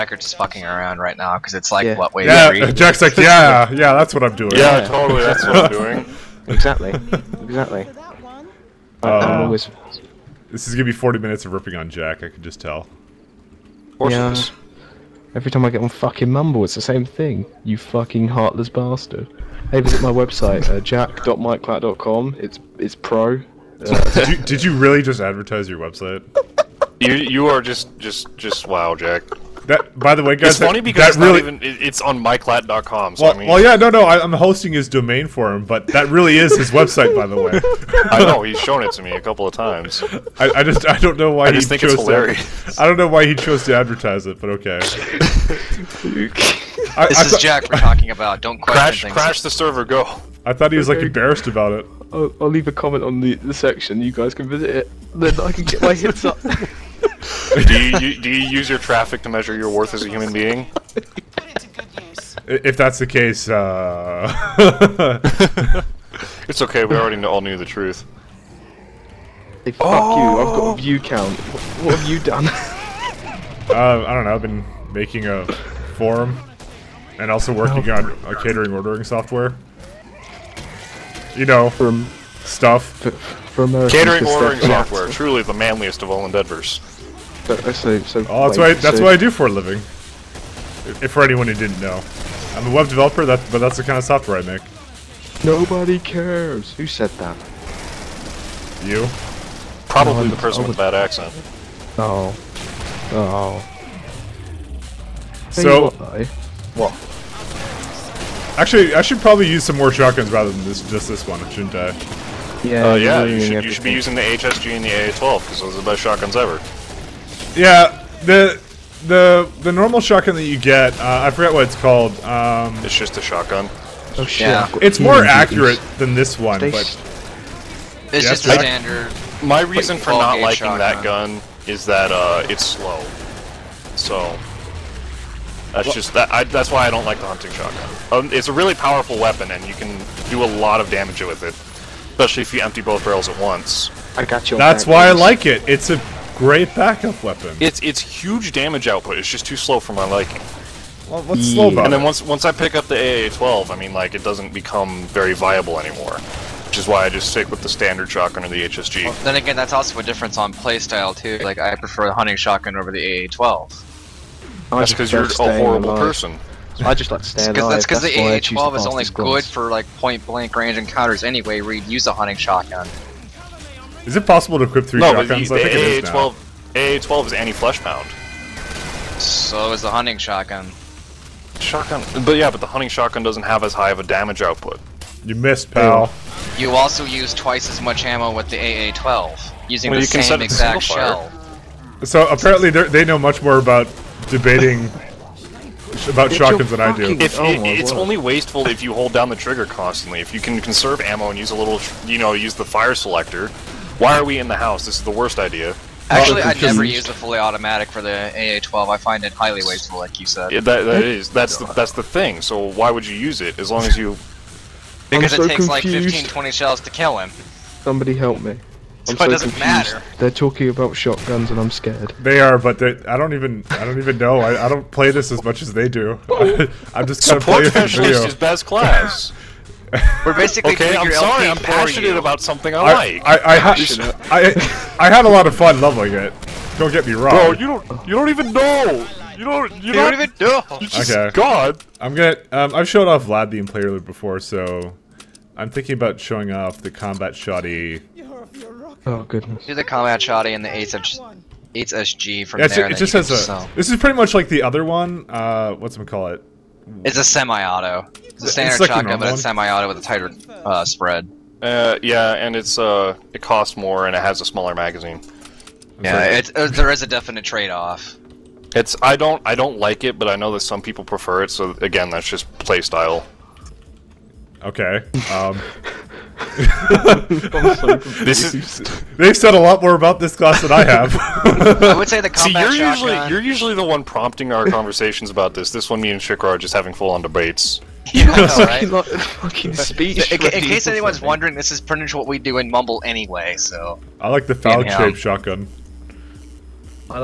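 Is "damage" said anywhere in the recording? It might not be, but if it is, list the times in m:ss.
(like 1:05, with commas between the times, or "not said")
2:20, 2:28, 3:04.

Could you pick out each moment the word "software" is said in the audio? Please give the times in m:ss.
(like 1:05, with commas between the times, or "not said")
1:19, 1:24, 1:34.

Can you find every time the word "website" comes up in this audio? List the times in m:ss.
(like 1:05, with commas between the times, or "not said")
0:20, 0:25, 0:36.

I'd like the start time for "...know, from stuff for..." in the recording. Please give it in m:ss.
1:21.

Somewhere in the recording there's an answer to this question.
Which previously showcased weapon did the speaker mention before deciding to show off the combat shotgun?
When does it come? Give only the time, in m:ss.
4:03.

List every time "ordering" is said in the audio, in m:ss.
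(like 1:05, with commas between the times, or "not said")
1:18, 1:24.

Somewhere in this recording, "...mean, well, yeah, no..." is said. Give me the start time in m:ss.
0:33.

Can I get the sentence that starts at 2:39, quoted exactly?
Well, then again, that's also a difference on playstyle too.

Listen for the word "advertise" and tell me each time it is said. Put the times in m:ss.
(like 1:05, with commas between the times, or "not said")
0:25, 0:43.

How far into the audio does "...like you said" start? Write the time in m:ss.
3:29.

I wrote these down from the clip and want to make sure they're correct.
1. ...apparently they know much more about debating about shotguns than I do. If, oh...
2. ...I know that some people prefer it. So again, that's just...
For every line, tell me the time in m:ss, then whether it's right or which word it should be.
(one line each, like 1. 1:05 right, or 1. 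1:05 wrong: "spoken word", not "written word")
1. 3:12 right
2. 4:30 right.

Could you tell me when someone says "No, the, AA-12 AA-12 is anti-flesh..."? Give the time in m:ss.
2:55.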